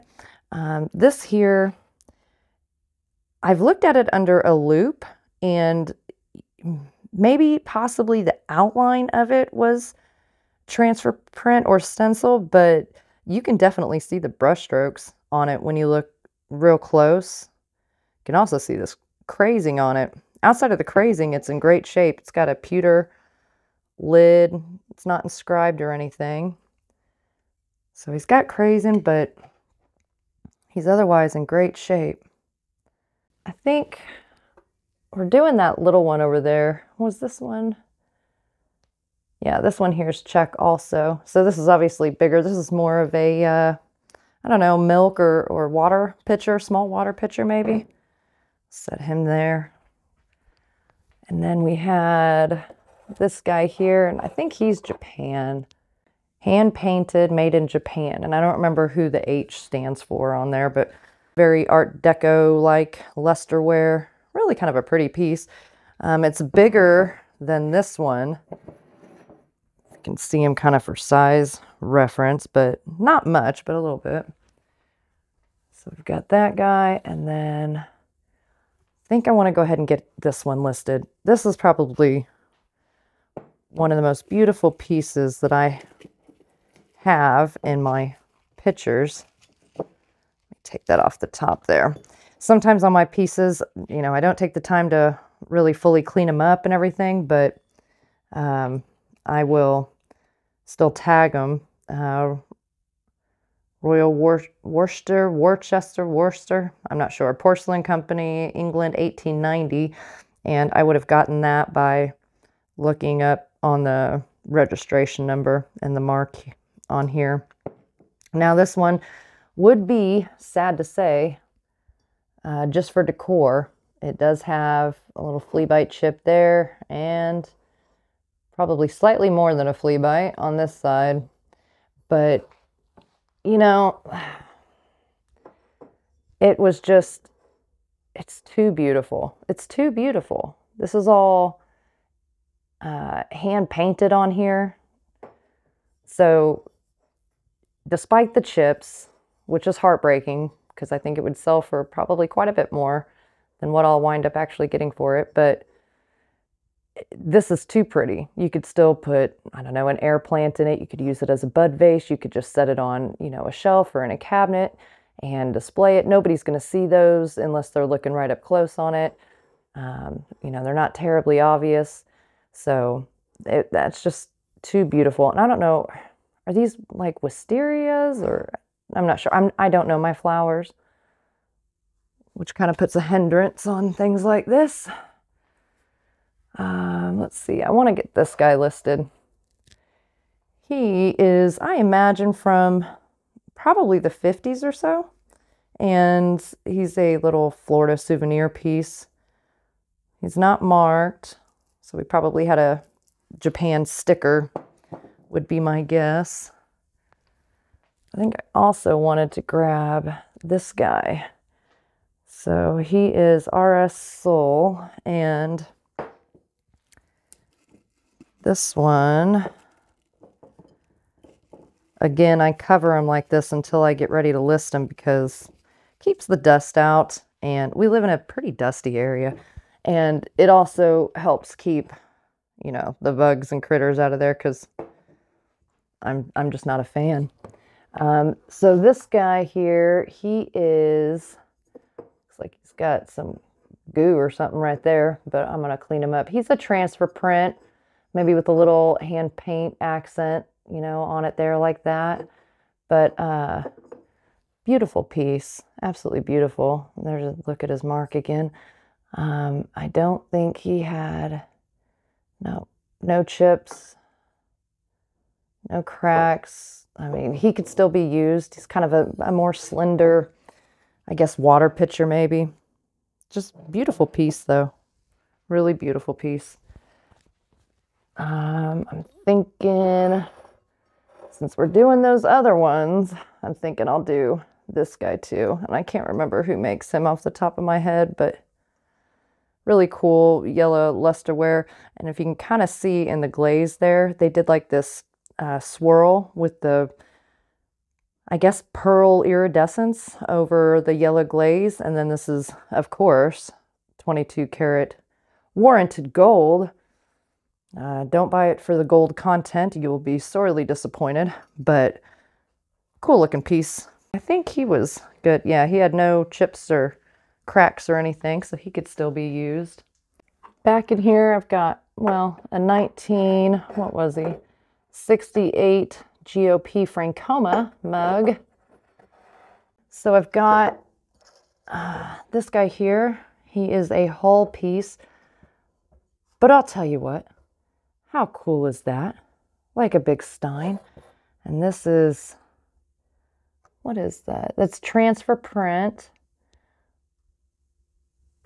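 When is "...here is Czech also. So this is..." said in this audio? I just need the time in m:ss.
0:39.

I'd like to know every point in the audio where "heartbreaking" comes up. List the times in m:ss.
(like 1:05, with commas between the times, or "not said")
2:29.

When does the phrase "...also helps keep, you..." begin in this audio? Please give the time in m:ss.
3:50.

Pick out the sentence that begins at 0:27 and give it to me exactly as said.
So he's got crazing, but he's otherwise in great shape.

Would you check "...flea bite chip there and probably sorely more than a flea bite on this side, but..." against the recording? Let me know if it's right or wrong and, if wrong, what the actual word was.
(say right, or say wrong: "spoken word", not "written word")
wrong: "slightly", not "sorely".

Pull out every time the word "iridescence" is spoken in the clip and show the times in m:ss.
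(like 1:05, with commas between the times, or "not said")
4:59.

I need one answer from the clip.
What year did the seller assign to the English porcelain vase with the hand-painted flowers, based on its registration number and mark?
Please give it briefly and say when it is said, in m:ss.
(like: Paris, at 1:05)
1890, at 1:48.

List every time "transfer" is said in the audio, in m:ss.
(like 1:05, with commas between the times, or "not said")
0:10, 4:06, 5:44.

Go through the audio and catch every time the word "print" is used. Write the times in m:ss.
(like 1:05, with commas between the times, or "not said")
0:11, 4:07, 5:45.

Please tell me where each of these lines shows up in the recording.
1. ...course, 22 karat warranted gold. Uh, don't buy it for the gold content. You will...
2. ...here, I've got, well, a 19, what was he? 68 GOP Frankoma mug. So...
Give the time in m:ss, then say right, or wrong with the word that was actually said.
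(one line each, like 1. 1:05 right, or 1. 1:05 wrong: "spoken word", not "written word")
1. 5:02 right
2. 5:20 right.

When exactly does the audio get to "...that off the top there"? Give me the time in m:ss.
1:30.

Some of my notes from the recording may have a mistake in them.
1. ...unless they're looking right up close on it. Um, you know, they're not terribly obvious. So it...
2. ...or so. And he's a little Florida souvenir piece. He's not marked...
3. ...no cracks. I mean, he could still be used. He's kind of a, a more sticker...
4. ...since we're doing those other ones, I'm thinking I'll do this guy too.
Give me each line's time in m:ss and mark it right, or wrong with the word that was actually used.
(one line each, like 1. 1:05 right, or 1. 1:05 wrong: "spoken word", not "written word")
1. 2:47 right
2. 3:14 right
3. 4:25 wrong: "slender", not "sticker"
4. 4:41 right.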